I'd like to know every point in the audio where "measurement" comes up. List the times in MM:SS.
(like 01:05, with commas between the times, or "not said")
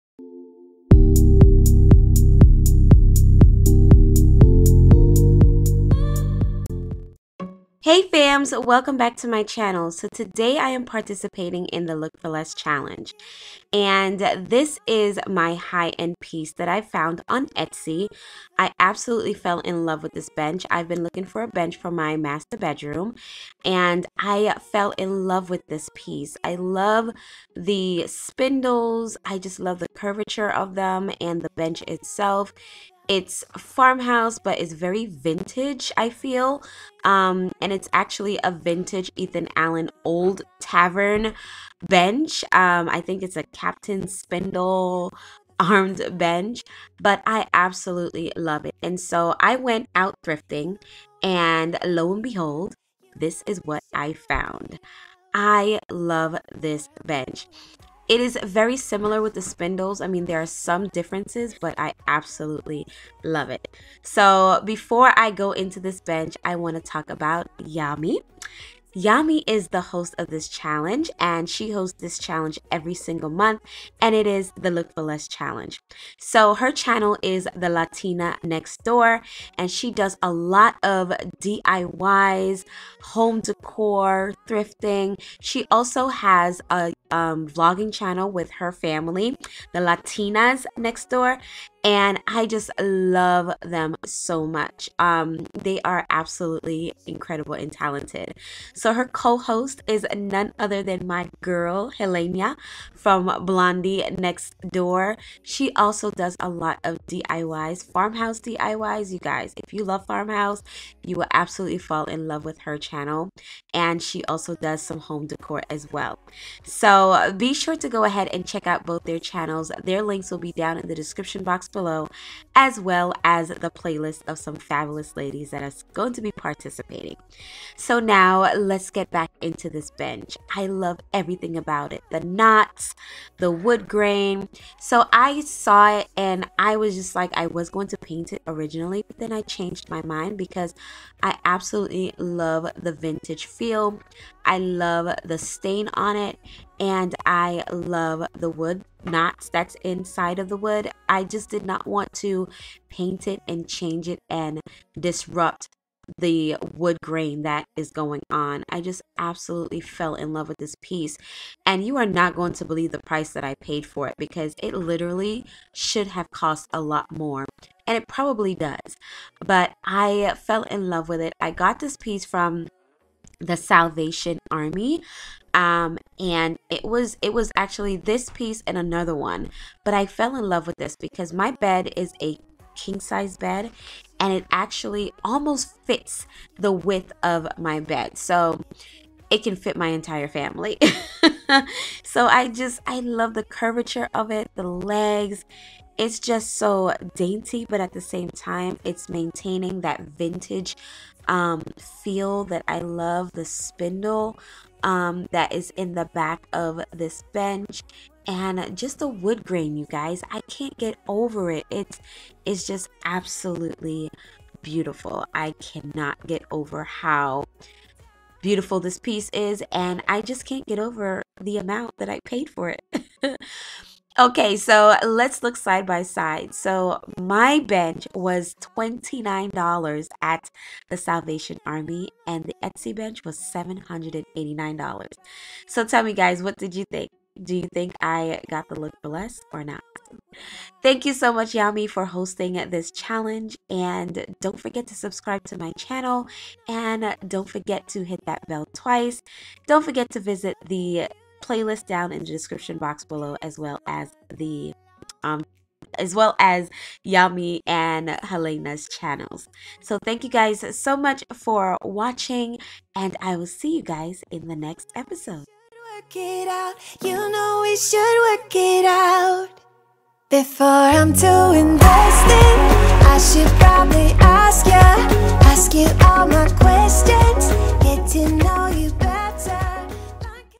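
not said.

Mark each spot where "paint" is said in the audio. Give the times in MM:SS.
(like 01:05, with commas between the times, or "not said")
02:17, 02:32.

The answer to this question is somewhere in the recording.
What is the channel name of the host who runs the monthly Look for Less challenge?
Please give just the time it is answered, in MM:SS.
01:17.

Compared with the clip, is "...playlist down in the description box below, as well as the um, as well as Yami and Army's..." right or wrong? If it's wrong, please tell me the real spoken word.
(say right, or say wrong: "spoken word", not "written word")
wrong: "Helena", not "Army".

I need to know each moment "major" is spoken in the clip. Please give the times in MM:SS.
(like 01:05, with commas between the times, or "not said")
not said.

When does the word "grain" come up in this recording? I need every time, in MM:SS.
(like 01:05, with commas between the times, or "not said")
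02:13, 02:37, 03:29.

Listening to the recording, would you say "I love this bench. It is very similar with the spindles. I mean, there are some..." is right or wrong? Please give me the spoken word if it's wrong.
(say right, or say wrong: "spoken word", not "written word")
right.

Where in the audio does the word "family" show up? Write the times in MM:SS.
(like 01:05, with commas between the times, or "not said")
01:28, 03:10.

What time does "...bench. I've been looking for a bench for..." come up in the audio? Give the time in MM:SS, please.
00:20.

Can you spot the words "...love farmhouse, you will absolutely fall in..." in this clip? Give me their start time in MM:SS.
01:49.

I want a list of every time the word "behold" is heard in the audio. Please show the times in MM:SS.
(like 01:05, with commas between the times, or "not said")
00:52.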